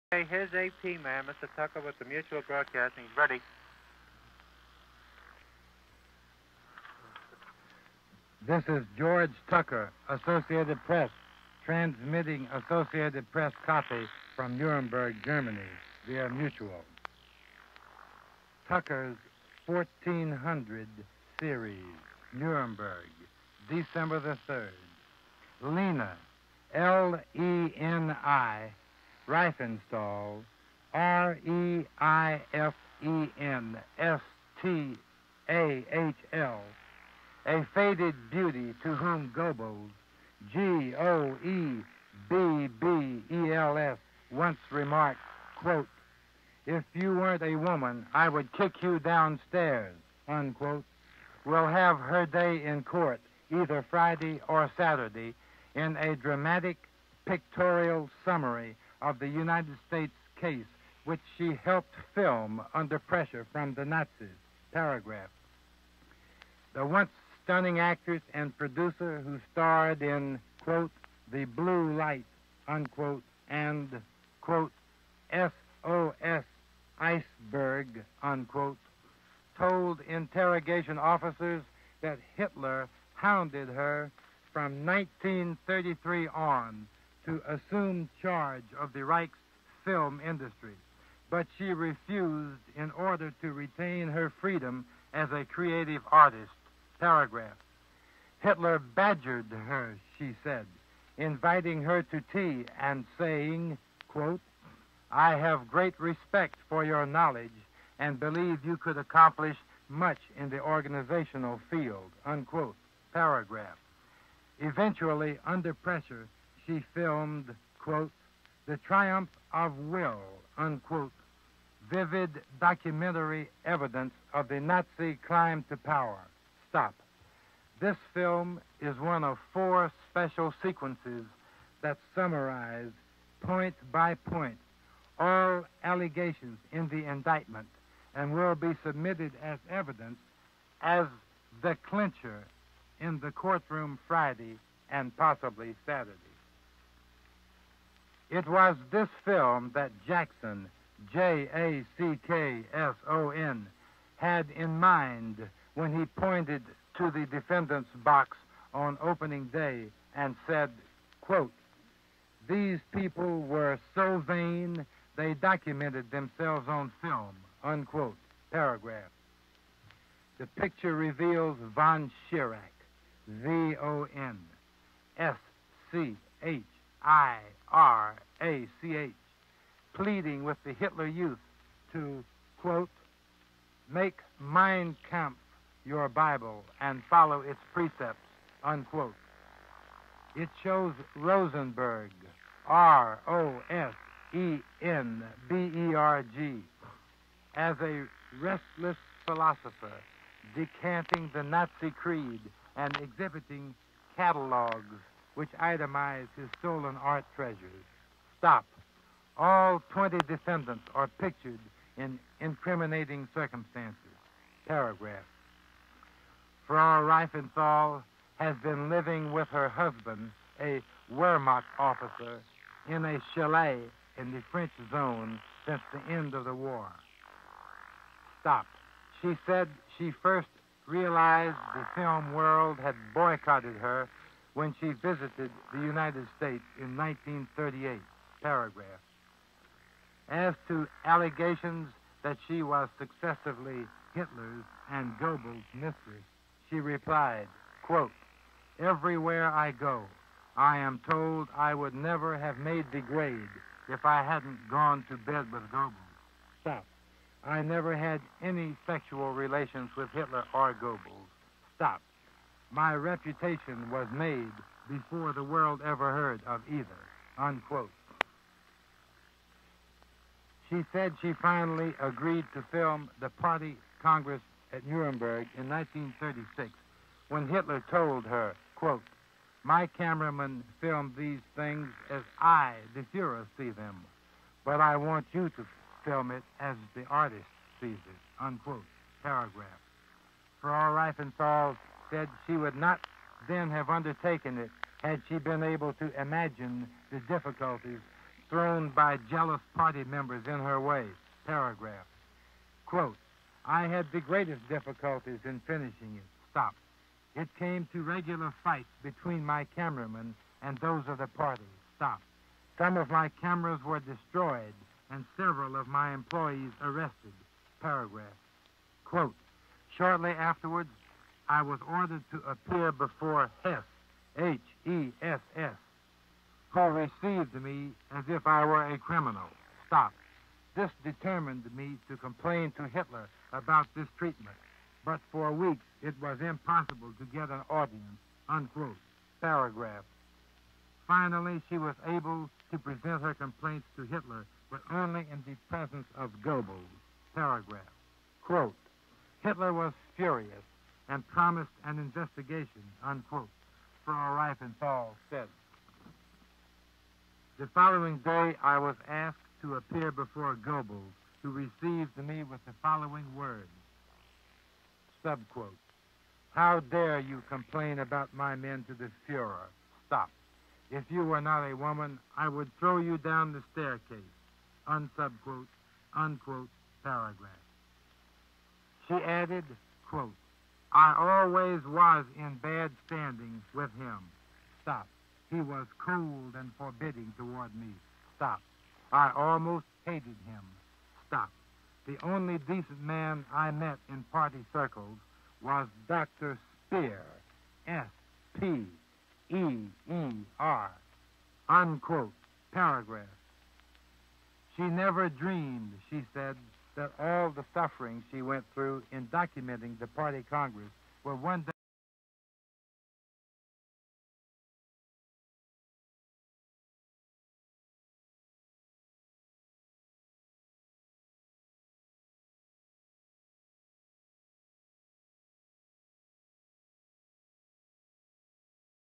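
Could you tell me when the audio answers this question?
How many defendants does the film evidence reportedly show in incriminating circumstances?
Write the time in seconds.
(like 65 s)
209 s.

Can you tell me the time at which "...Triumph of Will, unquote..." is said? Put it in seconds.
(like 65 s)
118 s.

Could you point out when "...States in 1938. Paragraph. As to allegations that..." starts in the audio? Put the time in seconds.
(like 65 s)
236 s.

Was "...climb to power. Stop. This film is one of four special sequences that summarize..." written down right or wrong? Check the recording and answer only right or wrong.
right.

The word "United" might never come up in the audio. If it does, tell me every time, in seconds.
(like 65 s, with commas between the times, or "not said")
59 s, 235 s.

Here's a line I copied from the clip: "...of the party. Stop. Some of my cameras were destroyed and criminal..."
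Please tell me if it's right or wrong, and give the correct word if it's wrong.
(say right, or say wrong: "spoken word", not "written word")
wrong: "several", not "criminal".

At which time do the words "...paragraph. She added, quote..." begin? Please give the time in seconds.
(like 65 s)
377 s.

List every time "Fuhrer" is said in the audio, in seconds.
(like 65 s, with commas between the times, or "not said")
283 s, 369 s.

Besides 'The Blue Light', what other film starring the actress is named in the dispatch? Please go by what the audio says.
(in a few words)
SOS Iceberg.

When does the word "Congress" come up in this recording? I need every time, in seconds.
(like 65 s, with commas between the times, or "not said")
274 s, 410 s.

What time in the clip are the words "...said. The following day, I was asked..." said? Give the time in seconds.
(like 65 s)
355 s.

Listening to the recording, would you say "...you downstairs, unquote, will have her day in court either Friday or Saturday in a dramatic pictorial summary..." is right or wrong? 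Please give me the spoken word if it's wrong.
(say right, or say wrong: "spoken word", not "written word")
right.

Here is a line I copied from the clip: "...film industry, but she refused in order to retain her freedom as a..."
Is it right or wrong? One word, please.
right.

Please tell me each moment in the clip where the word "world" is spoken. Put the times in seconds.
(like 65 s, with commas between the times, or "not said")
232 s, 265 s.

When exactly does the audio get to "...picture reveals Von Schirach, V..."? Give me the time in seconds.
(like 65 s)
170 s.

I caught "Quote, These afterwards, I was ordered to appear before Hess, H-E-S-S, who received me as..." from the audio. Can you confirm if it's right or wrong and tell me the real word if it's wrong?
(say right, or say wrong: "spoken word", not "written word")
wrong: "Shortly", not "These".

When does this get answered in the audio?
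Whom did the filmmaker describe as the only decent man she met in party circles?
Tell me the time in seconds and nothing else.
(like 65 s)
396 s.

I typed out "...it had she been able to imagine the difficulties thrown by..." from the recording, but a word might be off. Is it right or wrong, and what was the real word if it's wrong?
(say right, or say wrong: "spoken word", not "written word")
right.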